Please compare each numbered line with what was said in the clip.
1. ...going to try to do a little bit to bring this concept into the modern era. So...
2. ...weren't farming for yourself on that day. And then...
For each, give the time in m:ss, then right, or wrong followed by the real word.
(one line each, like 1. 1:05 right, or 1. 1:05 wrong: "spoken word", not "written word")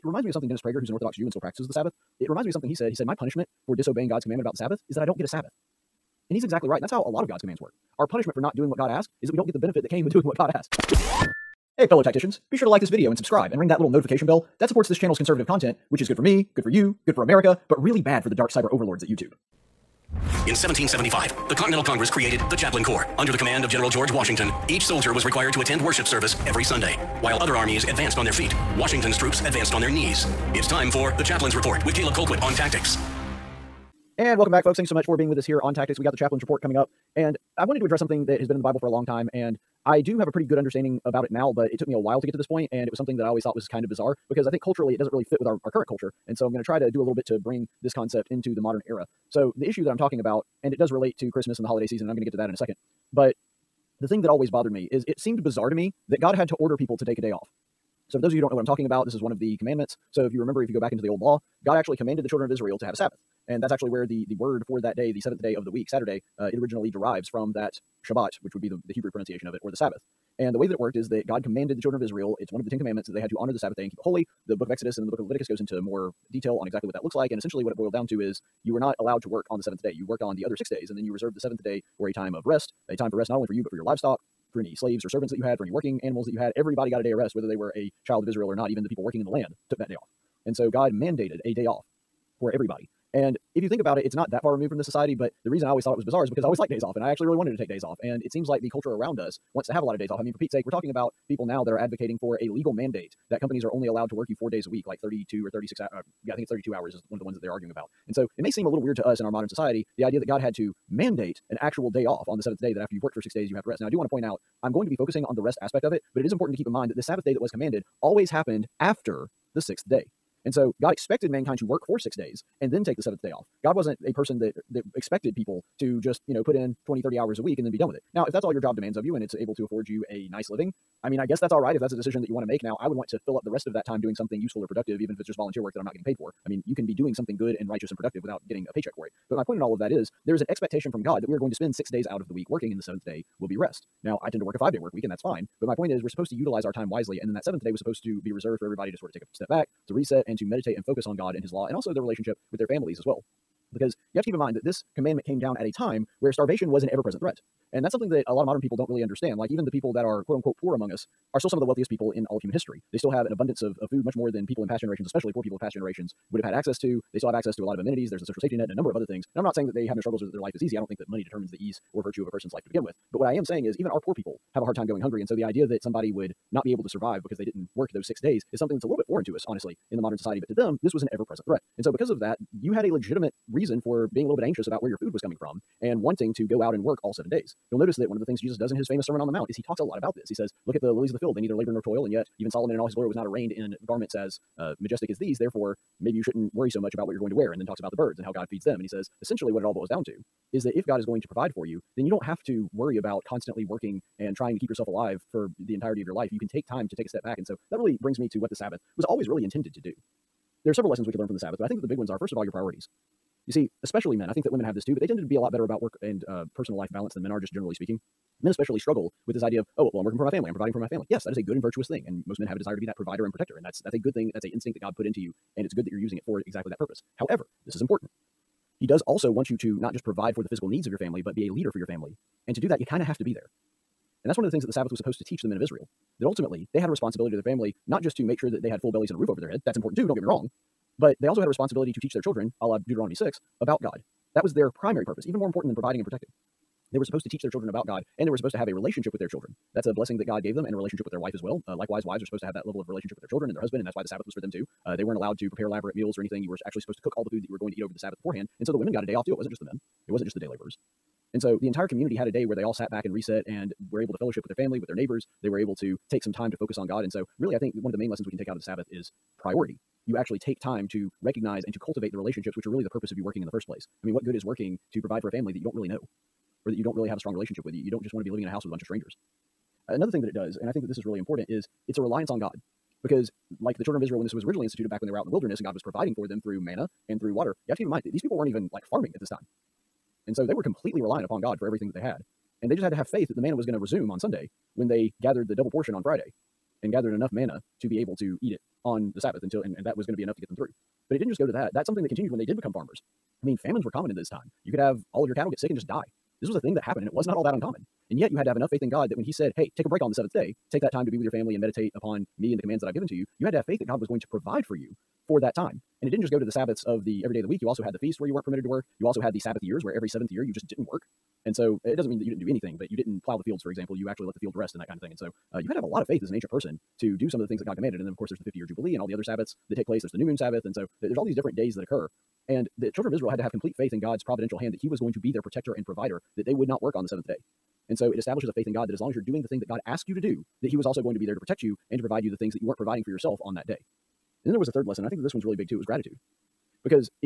1. 0:46 right
2. 5:42 wrong: "providing", not "farming".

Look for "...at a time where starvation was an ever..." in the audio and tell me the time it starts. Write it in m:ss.
2:35.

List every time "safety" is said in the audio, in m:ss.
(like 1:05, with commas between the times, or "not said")
2:48.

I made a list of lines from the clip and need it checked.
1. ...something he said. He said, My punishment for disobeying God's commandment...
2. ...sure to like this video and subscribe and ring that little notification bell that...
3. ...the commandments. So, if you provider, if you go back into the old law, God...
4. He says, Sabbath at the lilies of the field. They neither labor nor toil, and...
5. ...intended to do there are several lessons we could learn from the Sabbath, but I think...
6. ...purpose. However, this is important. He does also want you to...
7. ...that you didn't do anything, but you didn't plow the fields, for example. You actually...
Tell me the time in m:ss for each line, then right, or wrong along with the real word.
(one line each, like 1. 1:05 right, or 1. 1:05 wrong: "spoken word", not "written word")
1. 0:02 right
2. 0:12 right
3. 0:59 wrong: "remember", not "provider"
4. 3:10 wrong: "Look", not "Sabbath"
5. 3:29 right
6. 3:46 right
7. 5:22 right.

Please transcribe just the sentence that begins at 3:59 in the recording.
That's important too, don't get me wrong.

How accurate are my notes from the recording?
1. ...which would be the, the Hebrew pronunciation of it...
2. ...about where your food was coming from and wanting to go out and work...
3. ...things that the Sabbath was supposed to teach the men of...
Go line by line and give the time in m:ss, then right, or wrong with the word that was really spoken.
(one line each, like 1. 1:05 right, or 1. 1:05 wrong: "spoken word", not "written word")
1. 1:08 right
2. 3:04 right
3. 3:54 right.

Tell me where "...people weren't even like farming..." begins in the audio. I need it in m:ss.
4:48.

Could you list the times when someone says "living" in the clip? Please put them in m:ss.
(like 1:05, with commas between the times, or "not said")
2:10, 4:38.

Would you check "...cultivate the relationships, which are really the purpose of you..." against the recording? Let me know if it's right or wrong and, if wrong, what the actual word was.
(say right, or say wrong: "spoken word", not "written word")
right.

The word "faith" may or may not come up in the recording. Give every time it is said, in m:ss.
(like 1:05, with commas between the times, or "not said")
4:53, 5:08, 5:13, 5:26, 5:33, 5:38.